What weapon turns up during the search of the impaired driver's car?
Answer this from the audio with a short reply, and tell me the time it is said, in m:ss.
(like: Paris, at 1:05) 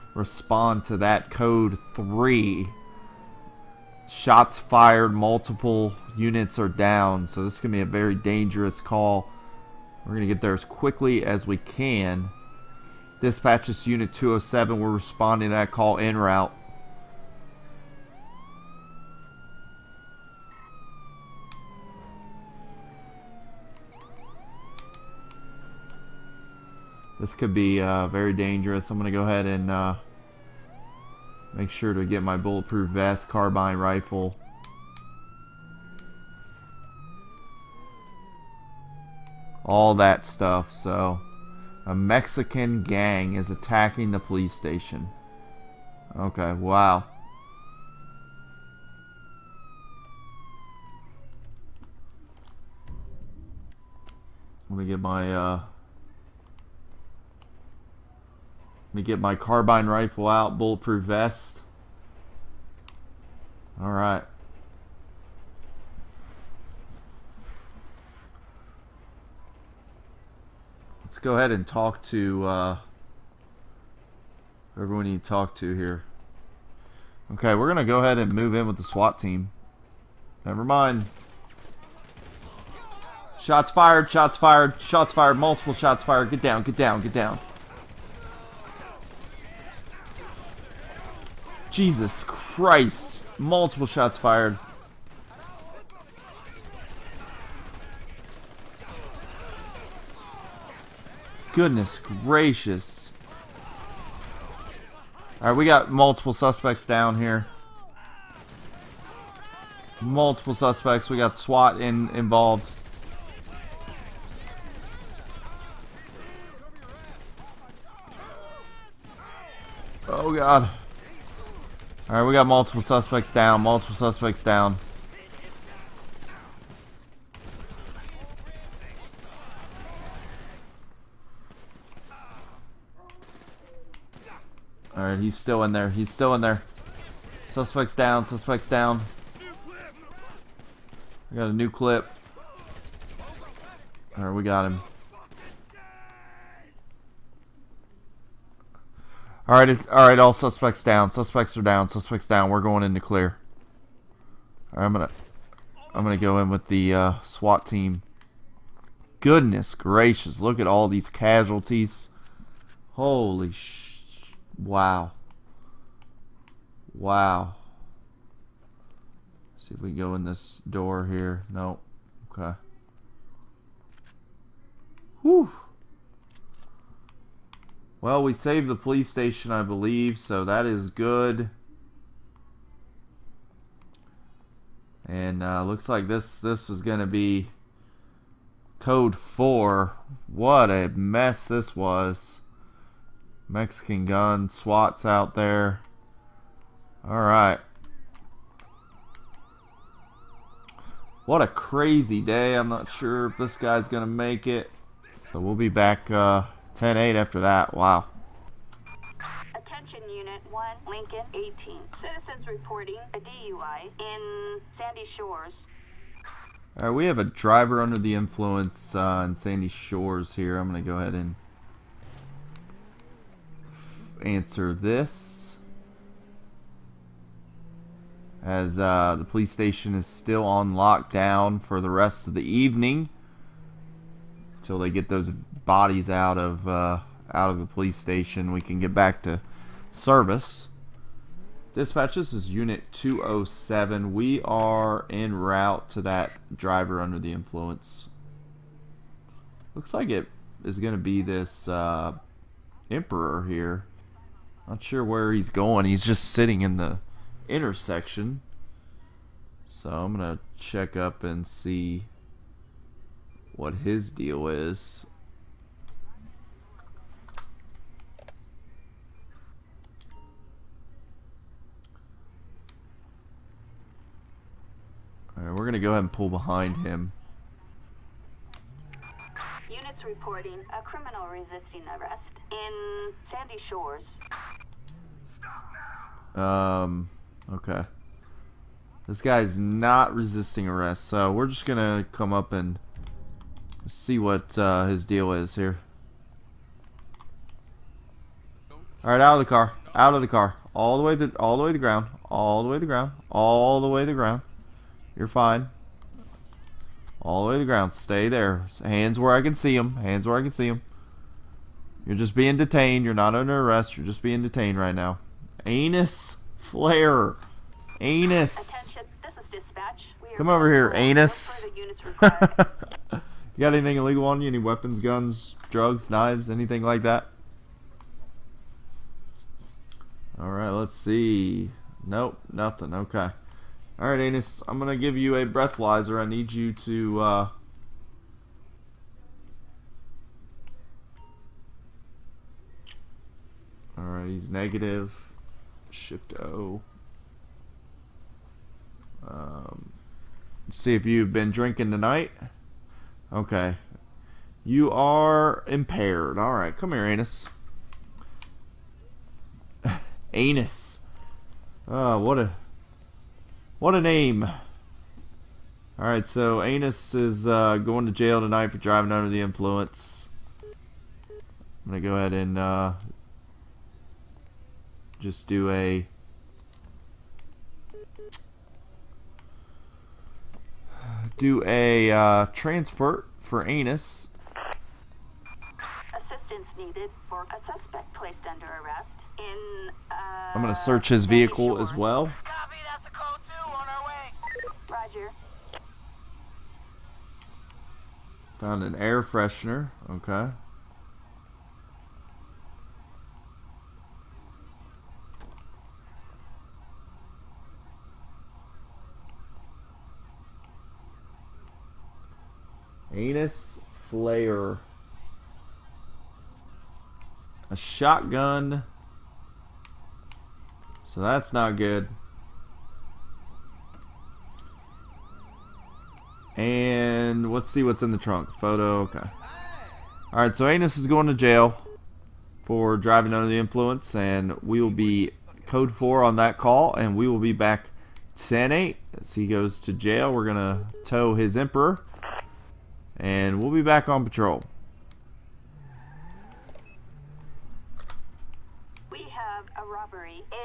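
A shotgun, at 6:57.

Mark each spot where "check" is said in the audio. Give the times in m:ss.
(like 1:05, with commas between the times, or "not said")
4:20.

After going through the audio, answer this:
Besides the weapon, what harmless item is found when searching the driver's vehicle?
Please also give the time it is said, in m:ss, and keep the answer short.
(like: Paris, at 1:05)
Air freshener, at 6:38.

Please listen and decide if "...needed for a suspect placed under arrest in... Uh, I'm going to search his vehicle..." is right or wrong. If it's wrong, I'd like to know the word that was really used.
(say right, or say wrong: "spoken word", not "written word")
right.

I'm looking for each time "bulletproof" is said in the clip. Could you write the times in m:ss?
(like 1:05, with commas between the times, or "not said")
0:32, 1:00.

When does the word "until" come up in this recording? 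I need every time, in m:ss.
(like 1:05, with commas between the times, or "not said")
3:54.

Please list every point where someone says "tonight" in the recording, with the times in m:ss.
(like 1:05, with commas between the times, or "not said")
5:51, 6:08.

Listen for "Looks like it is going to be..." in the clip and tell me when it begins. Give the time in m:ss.
4:09.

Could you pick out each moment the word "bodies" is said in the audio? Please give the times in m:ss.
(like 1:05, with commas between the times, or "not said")
3:55.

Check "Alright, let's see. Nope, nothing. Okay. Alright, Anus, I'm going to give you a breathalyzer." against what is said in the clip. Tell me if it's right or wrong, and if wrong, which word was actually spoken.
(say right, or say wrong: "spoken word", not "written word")
right.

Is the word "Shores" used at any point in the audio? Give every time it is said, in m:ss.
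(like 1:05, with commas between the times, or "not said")
3:35, 3:39, 4:43.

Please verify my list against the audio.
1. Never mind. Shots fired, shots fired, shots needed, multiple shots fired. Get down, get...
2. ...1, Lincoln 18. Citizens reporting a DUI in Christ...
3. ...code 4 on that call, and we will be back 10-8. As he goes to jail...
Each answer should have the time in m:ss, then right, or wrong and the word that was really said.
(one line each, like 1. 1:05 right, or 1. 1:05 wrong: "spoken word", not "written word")
1. 1:20 wrong: "fired", not "needed"
2. 3:30 wrong: "Sandy", not "Christ"
3. 7:15 right.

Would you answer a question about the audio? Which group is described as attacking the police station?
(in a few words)
A Mexican gang.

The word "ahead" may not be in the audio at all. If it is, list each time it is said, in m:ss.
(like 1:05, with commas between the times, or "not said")
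0:29, 1:11, 1:17, 3:40, 4:35, 6:12.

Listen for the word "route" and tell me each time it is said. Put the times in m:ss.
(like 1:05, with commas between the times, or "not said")
0:16, 4:05.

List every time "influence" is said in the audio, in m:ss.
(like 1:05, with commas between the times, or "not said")
3:38, 4:07, 6:09, 7:13.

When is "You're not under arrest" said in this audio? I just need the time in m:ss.
5:13.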